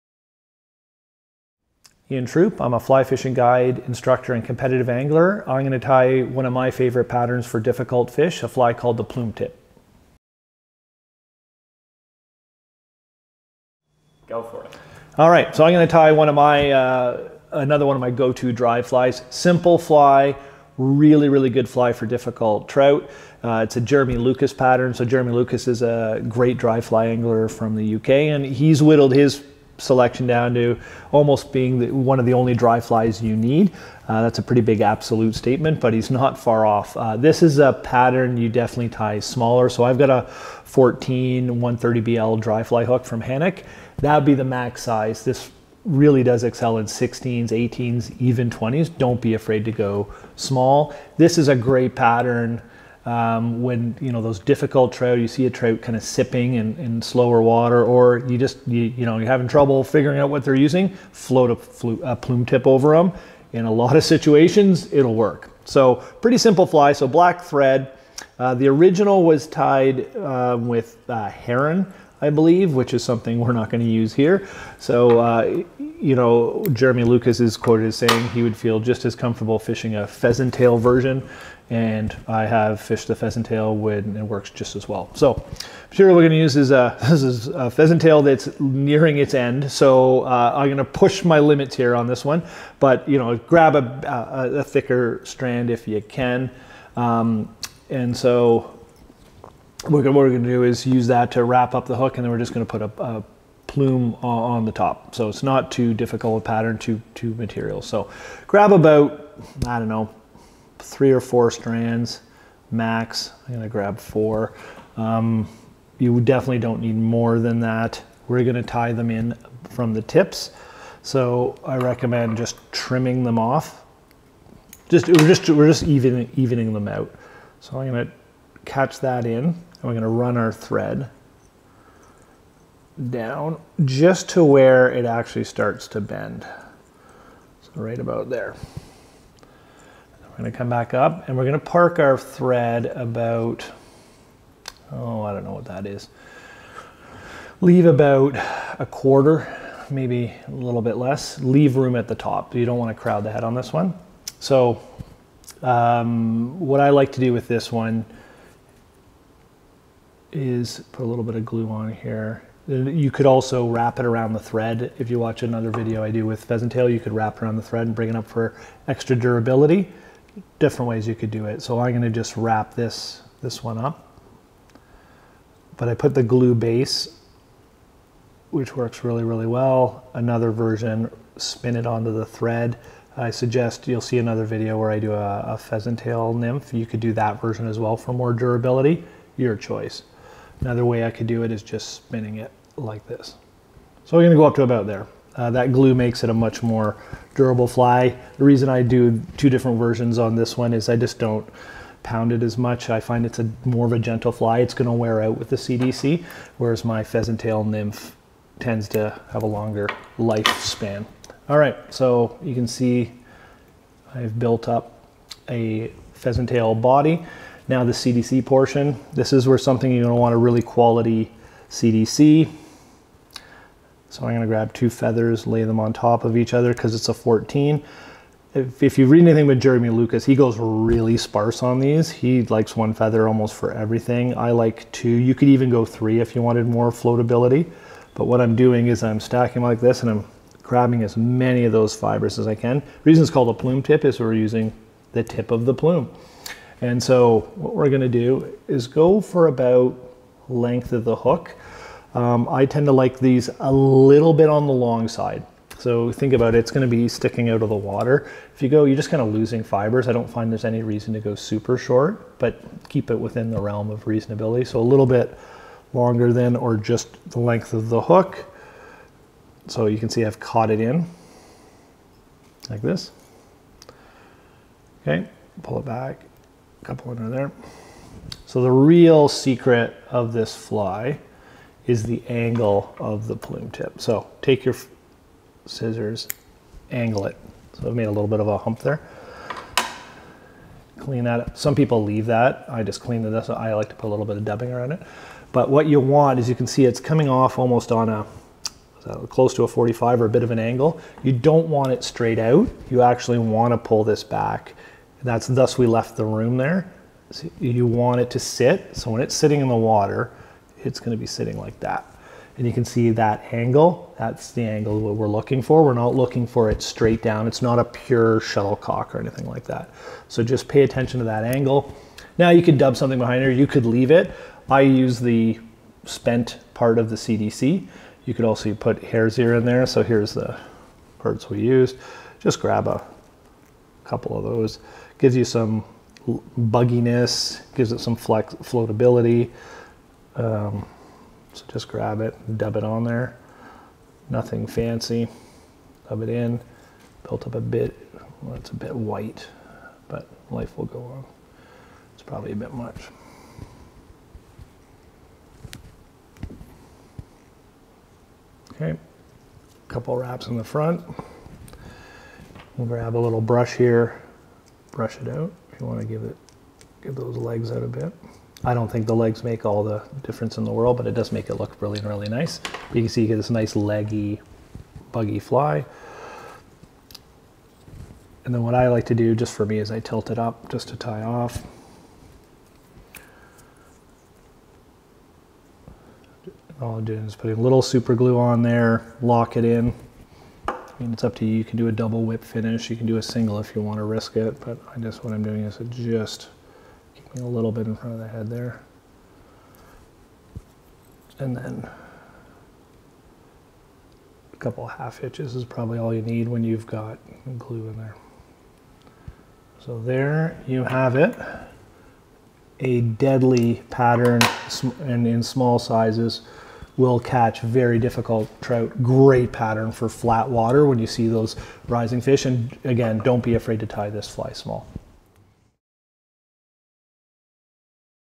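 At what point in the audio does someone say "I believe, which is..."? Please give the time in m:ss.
1:12.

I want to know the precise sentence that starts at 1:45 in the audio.
So it's not too difficult a pattern to, to material.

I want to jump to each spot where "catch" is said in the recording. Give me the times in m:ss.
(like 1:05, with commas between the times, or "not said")
2:08, 6:57.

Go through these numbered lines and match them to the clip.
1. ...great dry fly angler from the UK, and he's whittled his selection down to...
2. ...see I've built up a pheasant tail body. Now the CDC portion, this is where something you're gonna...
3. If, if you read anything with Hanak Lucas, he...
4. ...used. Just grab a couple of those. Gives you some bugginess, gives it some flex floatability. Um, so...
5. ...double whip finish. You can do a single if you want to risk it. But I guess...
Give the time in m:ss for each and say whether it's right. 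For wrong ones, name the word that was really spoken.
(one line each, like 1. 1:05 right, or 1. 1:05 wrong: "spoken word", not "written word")
1. 0:26 right
2. 3:32 right
3. 3:48 wrong: "Jeremy", not "Hanak"
4. 5:31 right
5. 6:31 right.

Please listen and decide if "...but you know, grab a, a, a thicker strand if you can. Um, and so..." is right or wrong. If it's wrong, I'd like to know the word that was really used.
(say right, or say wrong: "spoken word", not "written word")
right.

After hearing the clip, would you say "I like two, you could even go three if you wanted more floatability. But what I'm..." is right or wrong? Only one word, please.
right.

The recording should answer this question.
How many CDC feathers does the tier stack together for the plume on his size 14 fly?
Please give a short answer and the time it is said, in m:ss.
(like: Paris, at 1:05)
2, at 3:44.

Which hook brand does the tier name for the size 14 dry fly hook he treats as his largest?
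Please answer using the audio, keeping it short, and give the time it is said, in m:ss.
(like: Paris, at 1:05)
Hanak, at 0:43.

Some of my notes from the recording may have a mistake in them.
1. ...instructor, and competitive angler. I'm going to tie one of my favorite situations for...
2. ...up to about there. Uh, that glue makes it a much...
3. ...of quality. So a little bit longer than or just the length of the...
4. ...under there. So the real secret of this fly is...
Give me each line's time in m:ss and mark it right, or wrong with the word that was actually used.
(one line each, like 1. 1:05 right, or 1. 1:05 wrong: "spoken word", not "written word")
1. 0:03 wrong: "patterns", not "situations"
2. 3:14 right
3. 4:23 wrong: "reasonability", not "quality"
4. 4:37 right.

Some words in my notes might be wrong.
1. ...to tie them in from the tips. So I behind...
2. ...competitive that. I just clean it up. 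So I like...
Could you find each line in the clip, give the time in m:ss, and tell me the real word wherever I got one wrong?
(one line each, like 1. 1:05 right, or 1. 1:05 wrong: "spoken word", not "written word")
1. 1:58 wrong: "recommend", not "behind"
2. 4:52 wrong: "leave", not "competitive".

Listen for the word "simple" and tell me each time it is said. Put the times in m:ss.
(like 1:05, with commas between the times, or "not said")
0:19, 1:06.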